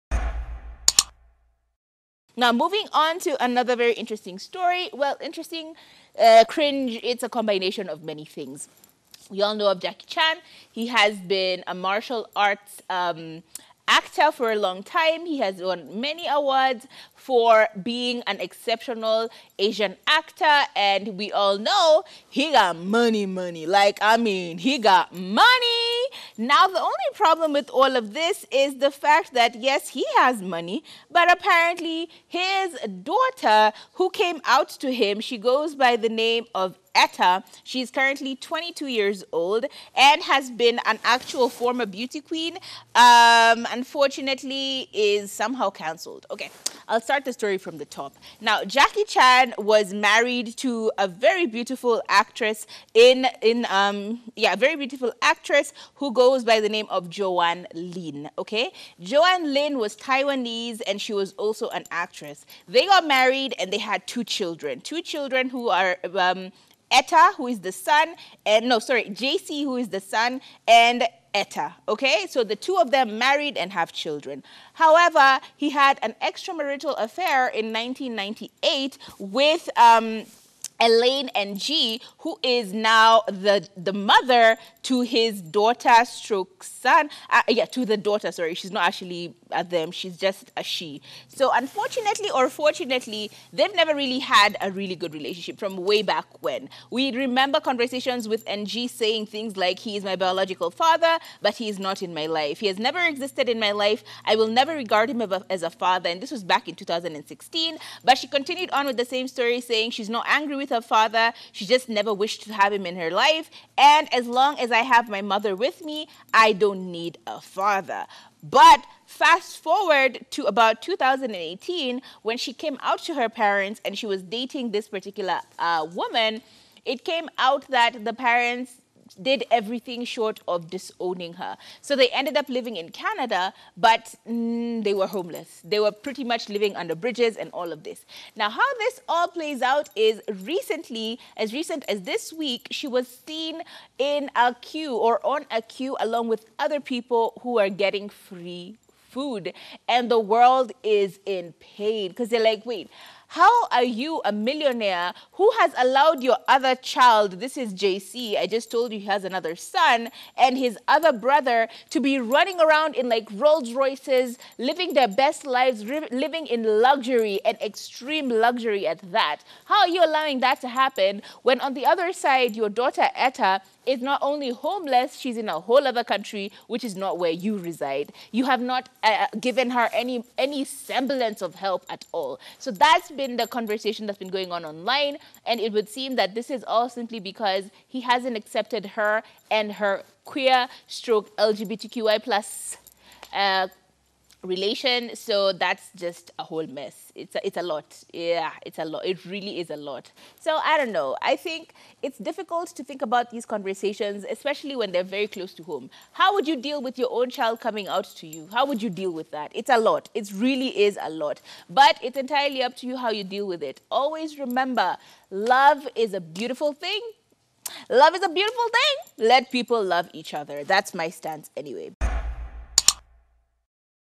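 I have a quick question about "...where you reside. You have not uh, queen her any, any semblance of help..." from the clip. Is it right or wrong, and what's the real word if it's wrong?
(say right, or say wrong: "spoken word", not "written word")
wrong: "given", not "queen".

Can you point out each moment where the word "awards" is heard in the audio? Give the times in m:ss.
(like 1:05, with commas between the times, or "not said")
0:16.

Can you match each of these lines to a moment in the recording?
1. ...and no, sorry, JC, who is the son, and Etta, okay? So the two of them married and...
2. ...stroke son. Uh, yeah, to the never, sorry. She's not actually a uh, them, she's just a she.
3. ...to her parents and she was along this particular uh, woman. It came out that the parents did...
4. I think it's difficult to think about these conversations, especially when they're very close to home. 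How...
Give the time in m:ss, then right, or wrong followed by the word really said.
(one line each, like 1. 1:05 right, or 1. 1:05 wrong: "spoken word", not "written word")
1. 1:08 right
2. 1:26 wrong: "daughter", not "never"
3. 2:03 wrong: "dating", not "along"
4. 3:21 right.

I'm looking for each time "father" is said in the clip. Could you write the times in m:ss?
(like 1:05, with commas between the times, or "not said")
1:40, 1:45, 1:50, 1:57.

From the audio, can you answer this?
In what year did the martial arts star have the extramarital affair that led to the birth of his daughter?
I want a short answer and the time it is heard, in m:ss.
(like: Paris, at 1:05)
1998, at 1:17.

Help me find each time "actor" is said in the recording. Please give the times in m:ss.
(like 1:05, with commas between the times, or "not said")
0:13, 0:20.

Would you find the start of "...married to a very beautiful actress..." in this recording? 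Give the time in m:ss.
0:49.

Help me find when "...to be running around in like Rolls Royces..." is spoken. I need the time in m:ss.
2:41.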